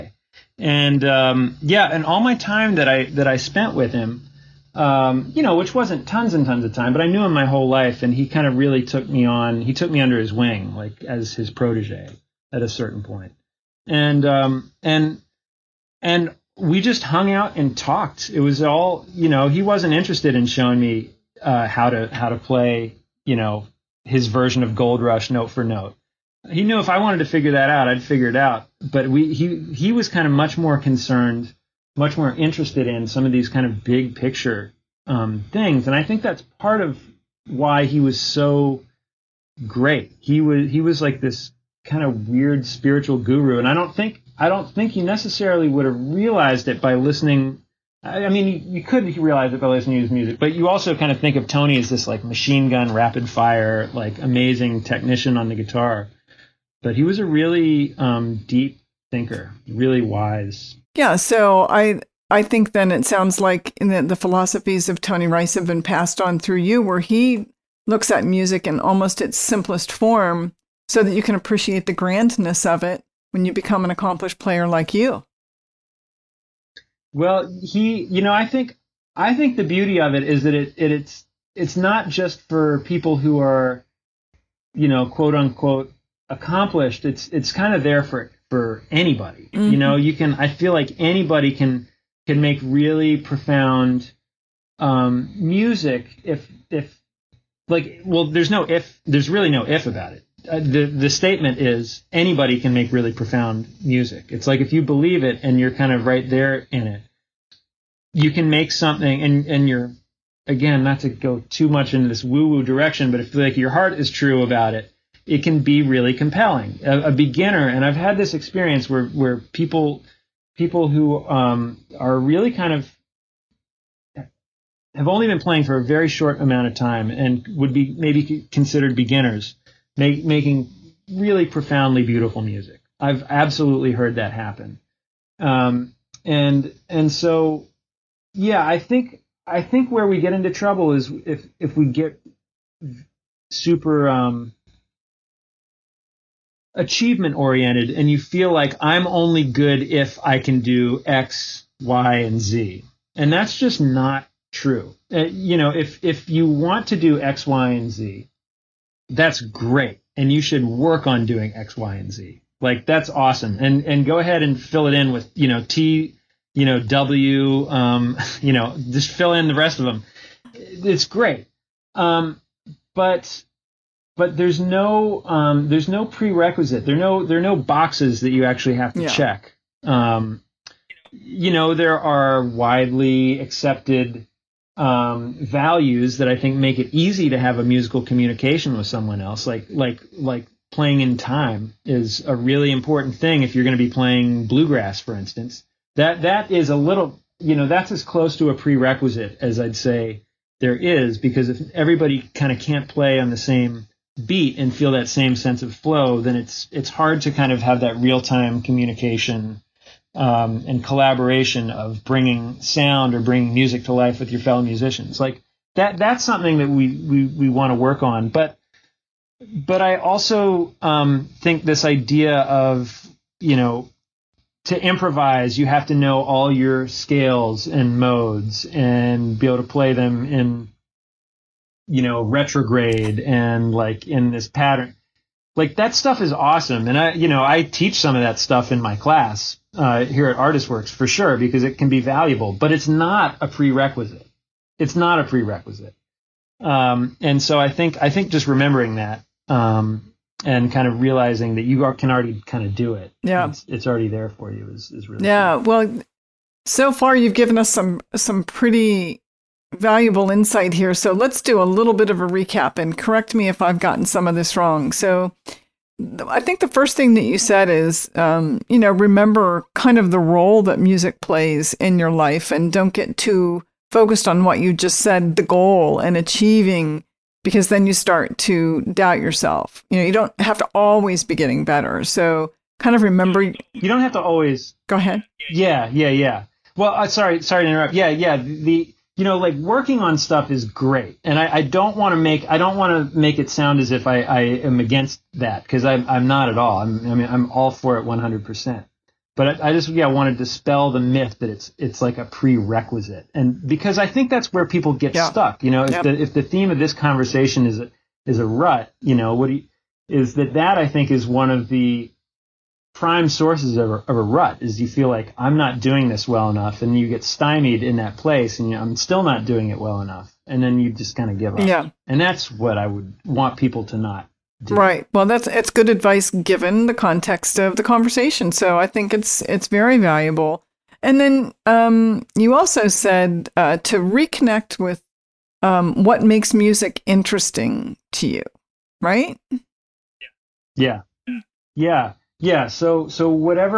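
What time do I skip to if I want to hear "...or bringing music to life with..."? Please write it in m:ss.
3:33.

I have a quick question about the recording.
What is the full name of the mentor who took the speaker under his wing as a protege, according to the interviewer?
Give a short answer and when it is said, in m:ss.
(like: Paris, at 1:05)
Tony Rice, at 1:05.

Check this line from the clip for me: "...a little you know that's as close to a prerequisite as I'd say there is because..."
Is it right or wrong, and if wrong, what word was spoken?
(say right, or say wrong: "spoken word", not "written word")
right.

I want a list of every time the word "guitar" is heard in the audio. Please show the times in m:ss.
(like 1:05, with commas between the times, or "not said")
0:55.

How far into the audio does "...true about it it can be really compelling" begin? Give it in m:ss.
1:54.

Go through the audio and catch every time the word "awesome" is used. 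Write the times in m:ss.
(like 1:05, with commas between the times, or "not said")
2:43, 3:56.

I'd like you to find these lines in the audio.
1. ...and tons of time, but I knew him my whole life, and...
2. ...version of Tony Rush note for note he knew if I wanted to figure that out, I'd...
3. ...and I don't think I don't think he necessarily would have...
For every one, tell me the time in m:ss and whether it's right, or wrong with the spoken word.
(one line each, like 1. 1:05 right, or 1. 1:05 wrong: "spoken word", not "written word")
1. 0:06 right
2. 0:24 wrong: "Gold", not "Tony"
3. 0:43 right.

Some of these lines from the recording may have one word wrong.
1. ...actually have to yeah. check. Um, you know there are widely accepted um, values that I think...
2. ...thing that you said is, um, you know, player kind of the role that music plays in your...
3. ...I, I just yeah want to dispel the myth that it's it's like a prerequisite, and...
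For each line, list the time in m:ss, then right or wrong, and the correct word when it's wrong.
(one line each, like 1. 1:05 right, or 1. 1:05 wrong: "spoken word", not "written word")
1. 2:58 right
2. 4:26 wrong: "remember", not "player"
3. 4:59 right.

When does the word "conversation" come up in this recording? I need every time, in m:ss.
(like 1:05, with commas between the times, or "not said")
5:06, 5:27.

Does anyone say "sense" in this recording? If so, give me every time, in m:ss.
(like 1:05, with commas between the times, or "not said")
3:25.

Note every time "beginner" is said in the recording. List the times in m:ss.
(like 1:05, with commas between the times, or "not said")
1:57, 2:08.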